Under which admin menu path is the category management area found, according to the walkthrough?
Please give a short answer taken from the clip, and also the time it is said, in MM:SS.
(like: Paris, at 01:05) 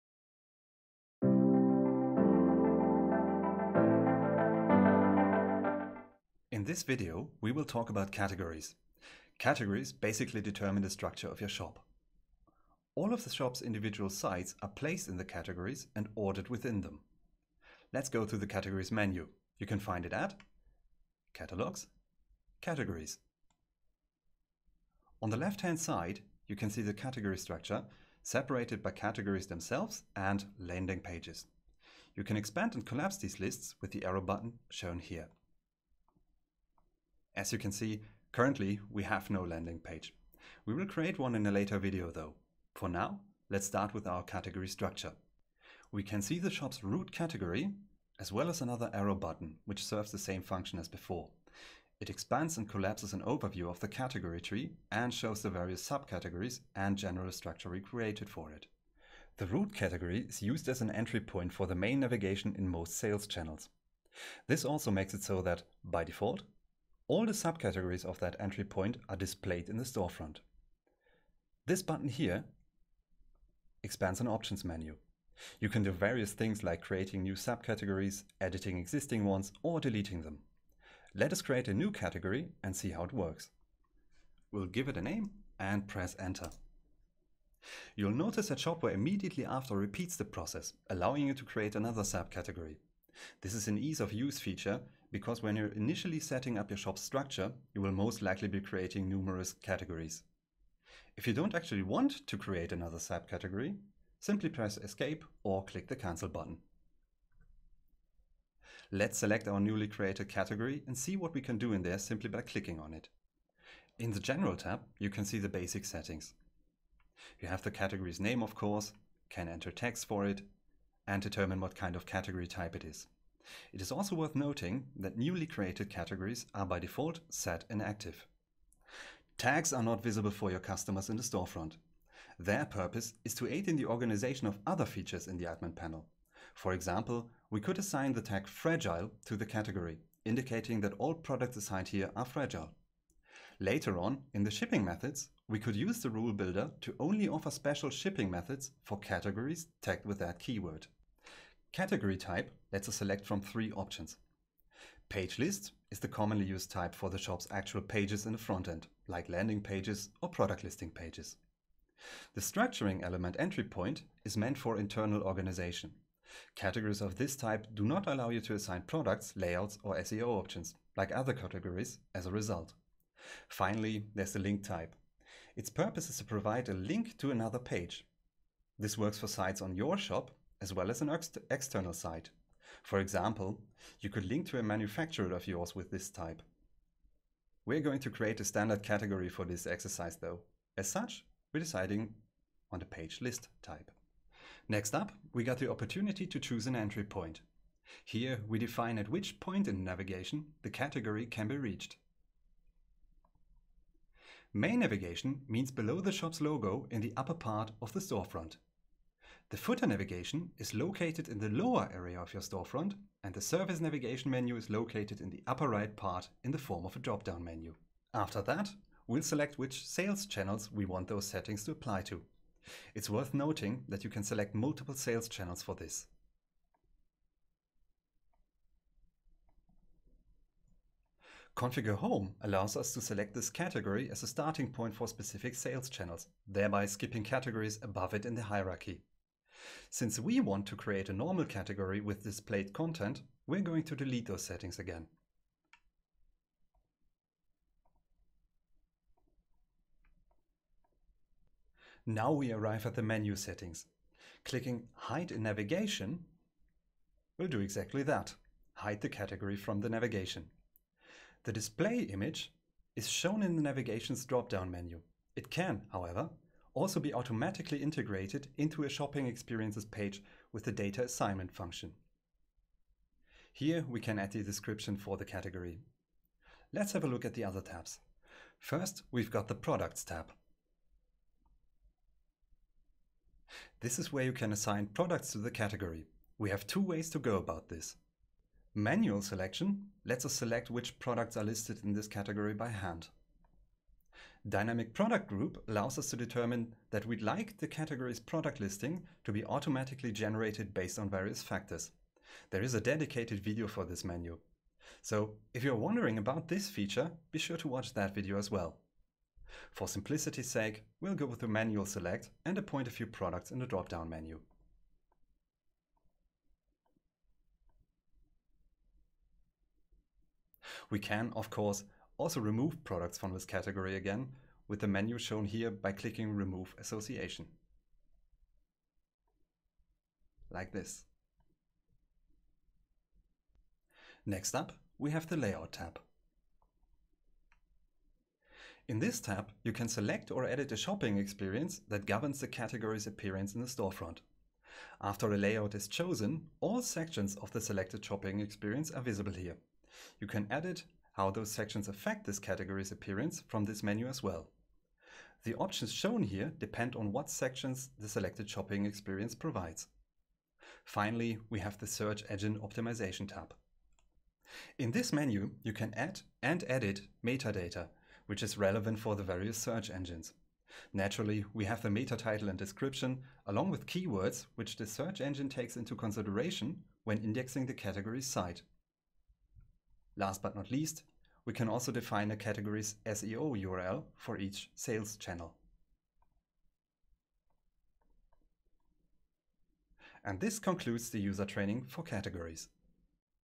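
Catalogs, Categories, at 00:21.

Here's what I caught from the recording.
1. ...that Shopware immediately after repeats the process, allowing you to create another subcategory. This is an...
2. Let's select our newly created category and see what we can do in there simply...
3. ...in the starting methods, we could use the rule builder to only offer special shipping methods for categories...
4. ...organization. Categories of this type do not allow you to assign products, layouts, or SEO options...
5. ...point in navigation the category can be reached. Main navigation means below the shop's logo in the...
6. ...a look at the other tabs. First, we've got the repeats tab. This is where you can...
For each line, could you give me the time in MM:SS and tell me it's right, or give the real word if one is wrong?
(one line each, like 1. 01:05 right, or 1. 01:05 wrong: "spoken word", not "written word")
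1. 01:28 right
2. 01:48 right
3. 02:24 wrong: "shipping", not "starting"
4. 02:45 right
5. 03:19 right
6. 04:37 wrong: "products", not "repeats".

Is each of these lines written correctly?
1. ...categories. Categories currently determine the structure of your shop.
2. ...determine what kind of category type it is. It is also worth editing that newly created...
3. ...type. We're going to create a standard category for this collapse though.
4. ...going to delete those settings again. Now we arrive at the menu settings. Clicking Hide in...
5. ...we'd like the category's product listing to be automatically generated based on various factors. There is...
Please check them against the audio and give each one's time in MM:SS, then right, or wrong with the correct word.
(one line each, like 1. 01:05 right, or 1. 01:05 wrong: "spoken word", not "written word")
1. 00:08 wrong: "basically", not "currently"
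2. 02:01 wrong: "noting", not "editing"
3. 03:06 wrong: "exercise", not "collapse"
4. 04:03 right
5. 04:57 right.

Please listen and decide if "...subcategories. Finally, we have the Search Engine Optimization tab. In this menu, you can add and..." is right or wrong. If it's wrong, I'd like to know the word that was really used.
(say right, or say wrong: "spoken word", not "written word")
wrong: "provides", not "subcategories".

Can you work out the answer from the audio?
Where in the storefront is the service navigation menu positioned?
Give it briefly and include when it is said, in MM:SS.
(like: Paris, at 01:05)
upper right, at 03:35.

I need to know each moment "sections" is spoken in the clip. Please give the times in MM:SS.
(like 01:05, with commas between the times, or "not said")
05:46, 05:51, 05:57.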